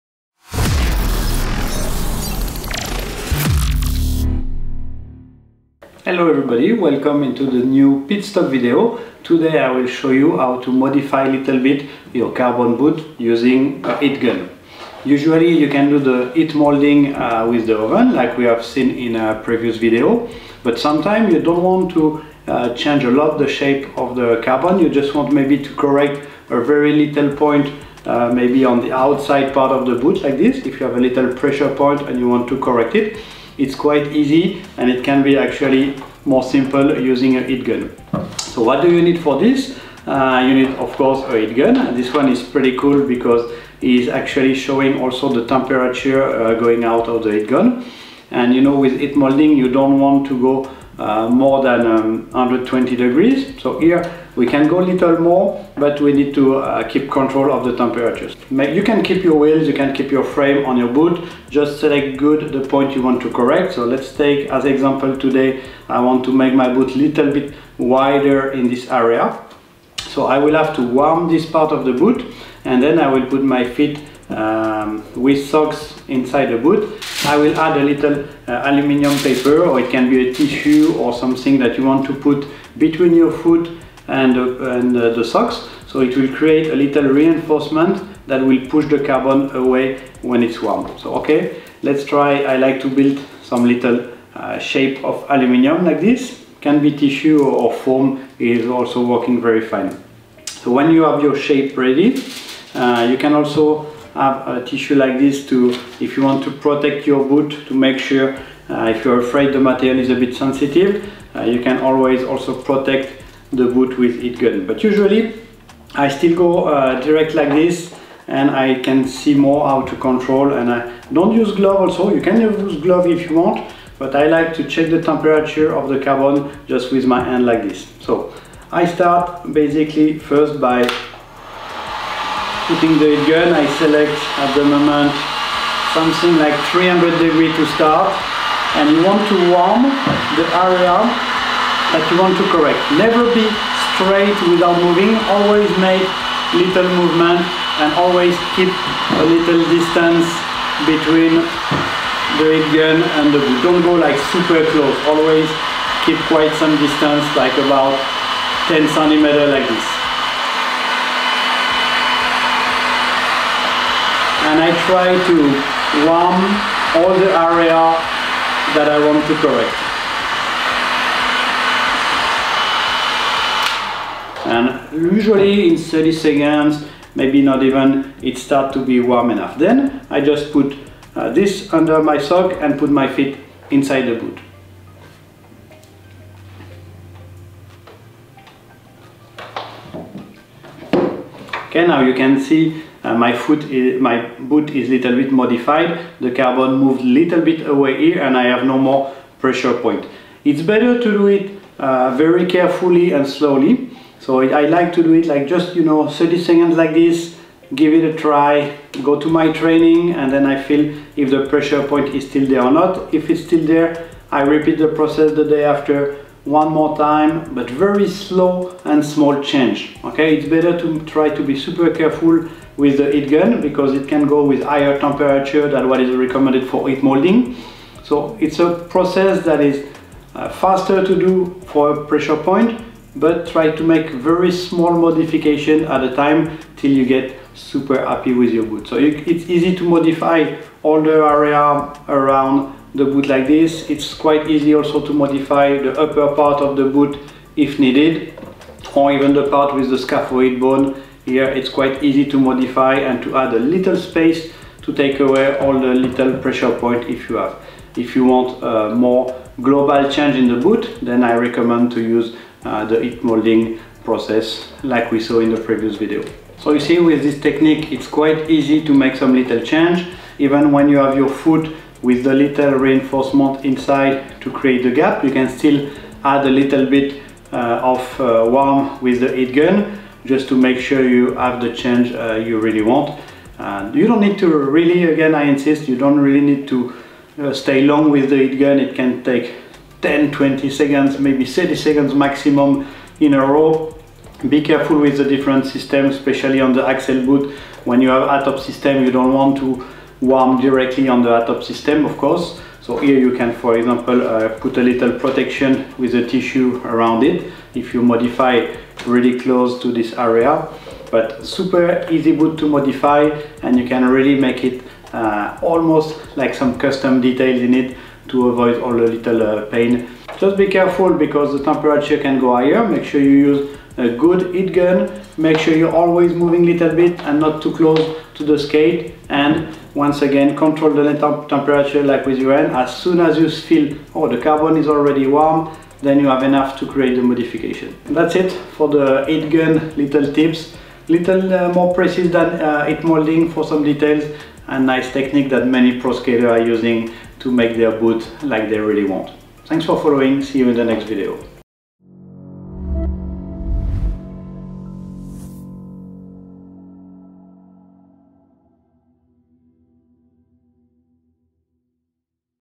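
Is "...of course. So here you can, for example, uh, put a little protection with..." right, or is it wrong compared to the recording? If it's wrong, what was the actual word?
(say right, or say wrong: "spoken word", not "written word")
right.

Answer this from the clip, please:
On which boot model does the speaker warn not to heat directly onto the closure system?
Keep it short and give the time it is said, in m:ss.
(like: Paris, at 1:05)
Accel, at 4:56.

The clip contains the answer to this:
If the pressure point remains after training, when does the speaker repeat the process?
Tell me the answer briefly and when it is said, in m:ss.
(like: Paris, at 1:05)
the day after, at 3:35.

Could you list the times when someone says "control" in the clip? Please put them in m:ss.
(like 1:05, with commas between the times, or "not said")
0:57, 1:59, 5:30.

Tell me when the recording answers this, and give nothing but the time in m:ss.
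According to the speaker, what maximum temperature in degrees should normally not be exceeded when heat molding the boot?
0:52.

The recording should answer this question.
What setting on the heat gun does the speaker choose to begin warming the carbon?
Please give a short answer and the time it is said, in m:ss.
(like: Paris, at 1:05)
300 degrees, at 2:16.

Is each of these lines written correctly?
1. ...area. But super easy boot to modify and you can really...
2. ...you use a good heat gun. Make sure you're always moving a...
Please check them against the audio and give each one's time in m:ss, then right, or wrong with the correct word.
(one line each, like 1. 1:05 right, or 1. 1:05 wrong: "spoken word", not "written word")
1. 5:10 right
2. 5:23 right.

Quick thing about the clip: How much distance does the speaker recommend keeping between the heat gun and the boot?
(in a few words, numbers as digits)
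10 centimeters.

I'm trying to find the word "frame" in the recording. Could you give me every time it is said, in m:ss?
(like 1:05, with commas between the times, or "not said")
1:00.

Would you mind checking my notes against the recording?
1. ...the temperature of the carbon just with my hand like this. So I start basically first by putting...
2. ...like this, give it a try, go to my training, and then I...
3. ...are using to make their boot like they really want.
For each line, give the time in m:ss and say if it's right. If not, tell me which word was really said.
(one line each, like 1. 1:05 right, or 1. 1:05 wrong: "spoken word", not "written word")
1. 2:04 right
2. 3:26 right
3. 5:46 right.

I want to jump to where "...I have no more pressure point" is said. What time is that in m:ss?
3:18.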